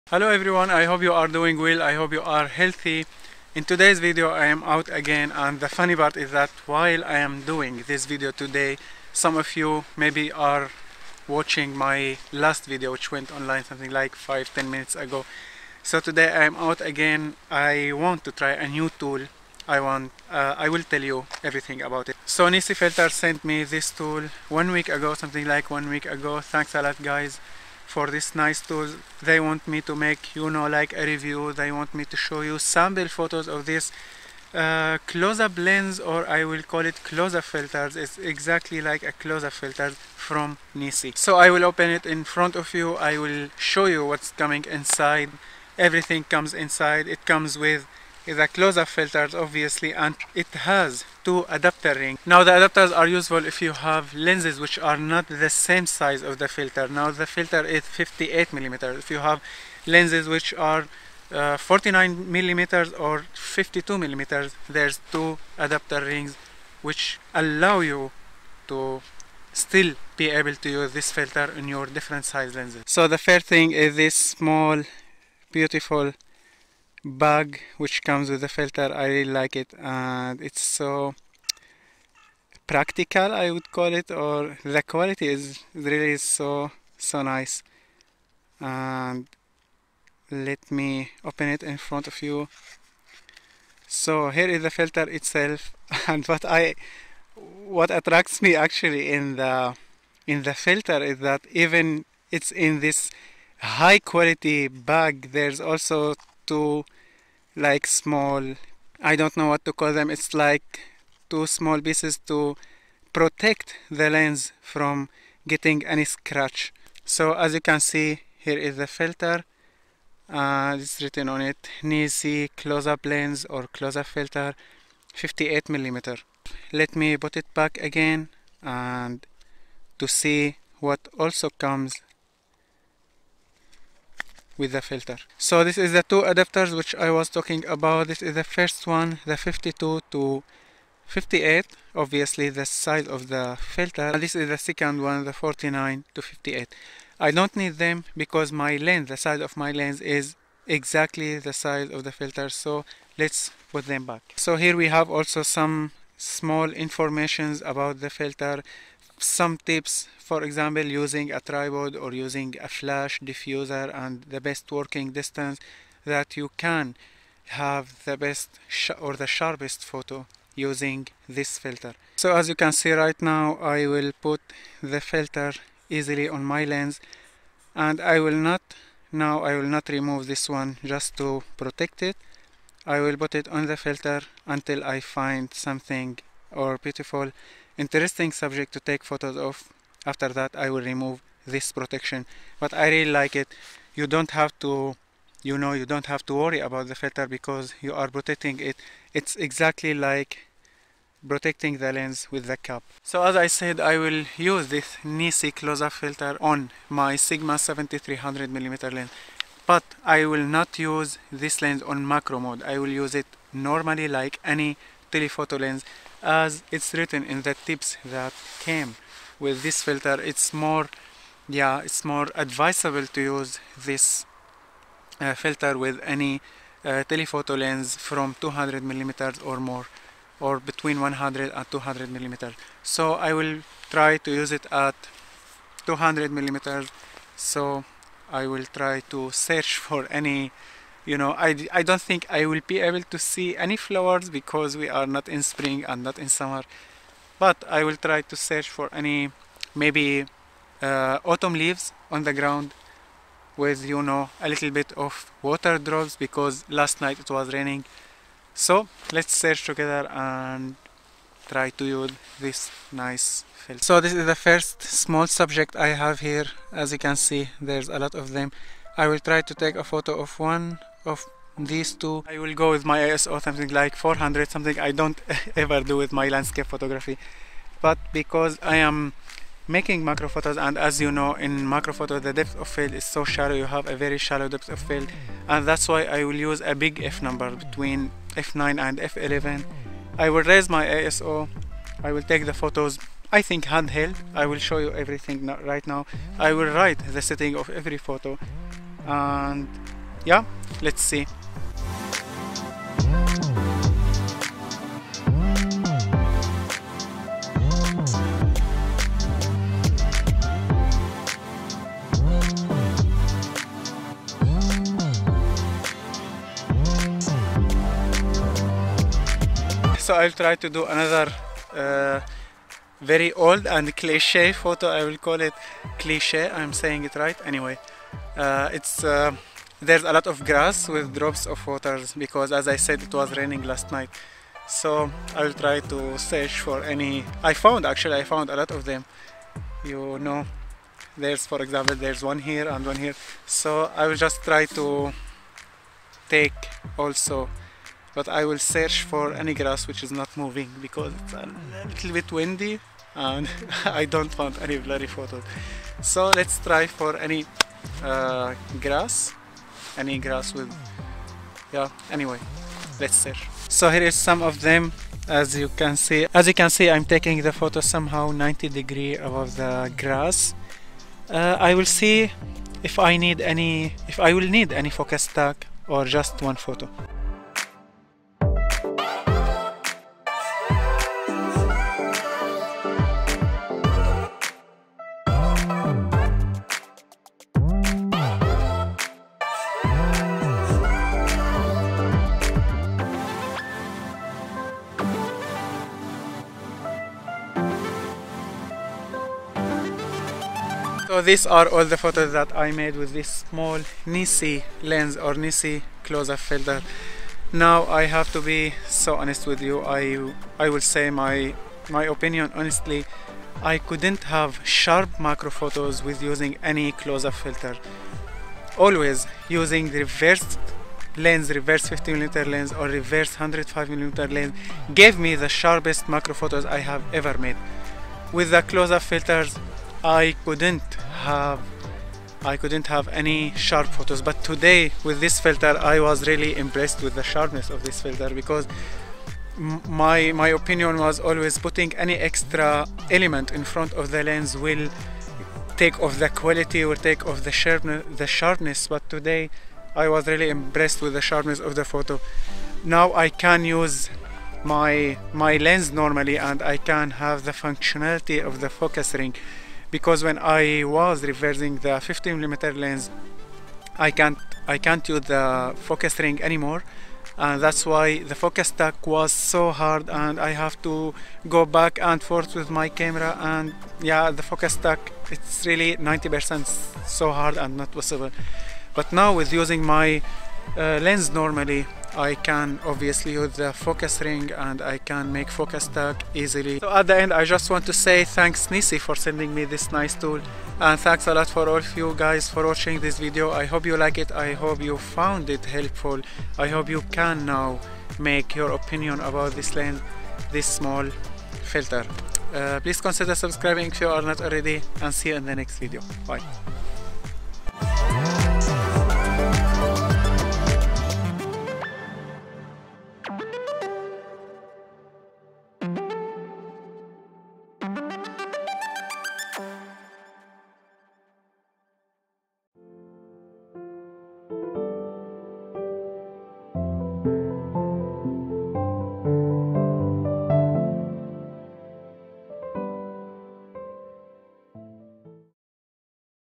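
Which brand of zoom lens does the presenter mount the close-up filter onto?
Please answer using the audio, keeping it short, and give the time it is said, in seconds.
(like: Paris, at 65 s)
Sigma, at 207 s.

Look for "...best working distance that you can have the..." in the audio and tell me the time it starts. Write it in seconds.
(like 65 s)
164 s.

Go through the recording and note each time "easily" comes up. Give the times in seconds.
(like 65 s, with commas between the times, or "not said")
175 s, 486 s.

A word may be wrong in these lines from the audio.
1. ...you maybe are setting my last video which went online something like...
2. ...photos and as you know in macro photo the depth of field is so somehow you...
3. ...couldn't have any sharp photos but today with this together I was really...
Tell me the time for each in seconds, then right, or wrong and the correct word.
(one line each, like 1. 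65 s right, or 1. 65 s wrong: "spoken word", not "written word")
1. 9 s wrong: "watching", not "setting"
2. 280 s wrong: "shallow", not "somehow"
3. 432 s wrong: "filter", not "together".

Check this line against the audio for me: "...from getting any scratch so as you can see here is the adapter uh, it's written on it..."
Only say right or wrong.
wrong.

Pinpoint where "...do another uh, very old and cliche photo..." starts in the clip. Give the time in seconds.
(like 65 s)
320 s.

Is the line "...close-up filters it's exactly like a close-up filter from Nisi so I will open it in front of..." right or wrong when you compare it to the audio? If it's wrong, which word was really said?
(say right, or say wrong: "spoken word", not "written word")
right.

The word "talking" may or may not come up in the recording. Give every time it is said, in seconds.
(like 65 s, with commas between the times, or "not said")
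137 s.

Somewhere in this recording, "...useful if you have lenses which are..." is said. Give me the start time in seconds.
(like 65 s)
53 s.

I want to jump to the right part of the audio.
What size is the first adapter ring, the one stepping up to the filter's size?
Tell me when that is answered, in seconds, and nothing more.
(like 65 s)
139 s.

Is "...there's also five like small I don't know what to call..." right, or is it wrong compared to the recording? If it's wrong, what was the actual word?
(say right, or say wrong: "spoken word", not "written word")
wrong: "two", not "five".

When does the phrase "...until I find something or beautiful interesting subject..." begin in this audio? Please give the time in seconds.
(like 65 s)
184 s.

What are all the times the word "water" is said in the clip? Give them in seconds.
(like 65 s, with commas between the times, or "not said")
255 s, 331 s.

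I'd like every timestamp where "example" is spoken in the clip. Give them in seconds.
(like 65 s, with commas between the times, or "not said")
160 s, 341 s.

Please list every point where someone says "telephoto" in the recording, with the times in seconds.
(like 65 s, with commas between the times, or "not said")
215 s, 227 s.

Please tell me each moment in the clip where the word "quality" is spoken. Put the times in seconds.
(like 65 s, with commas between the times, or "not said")
84 s, 103 s, 446 s.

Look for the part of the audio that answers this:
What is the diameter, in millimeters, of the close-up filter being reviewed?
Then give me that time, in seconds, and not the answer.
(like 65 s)
57 s.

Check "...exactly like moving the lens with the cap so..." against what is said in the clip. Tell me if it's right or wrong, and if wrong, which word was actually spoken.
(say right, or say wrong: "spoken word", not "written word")
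wrong: "protecting", not "moving".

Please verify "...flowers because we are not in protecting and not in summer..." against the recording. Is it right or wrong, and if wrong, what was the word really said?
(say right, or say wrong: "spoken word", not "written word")
wrong: "spring", not "protecting".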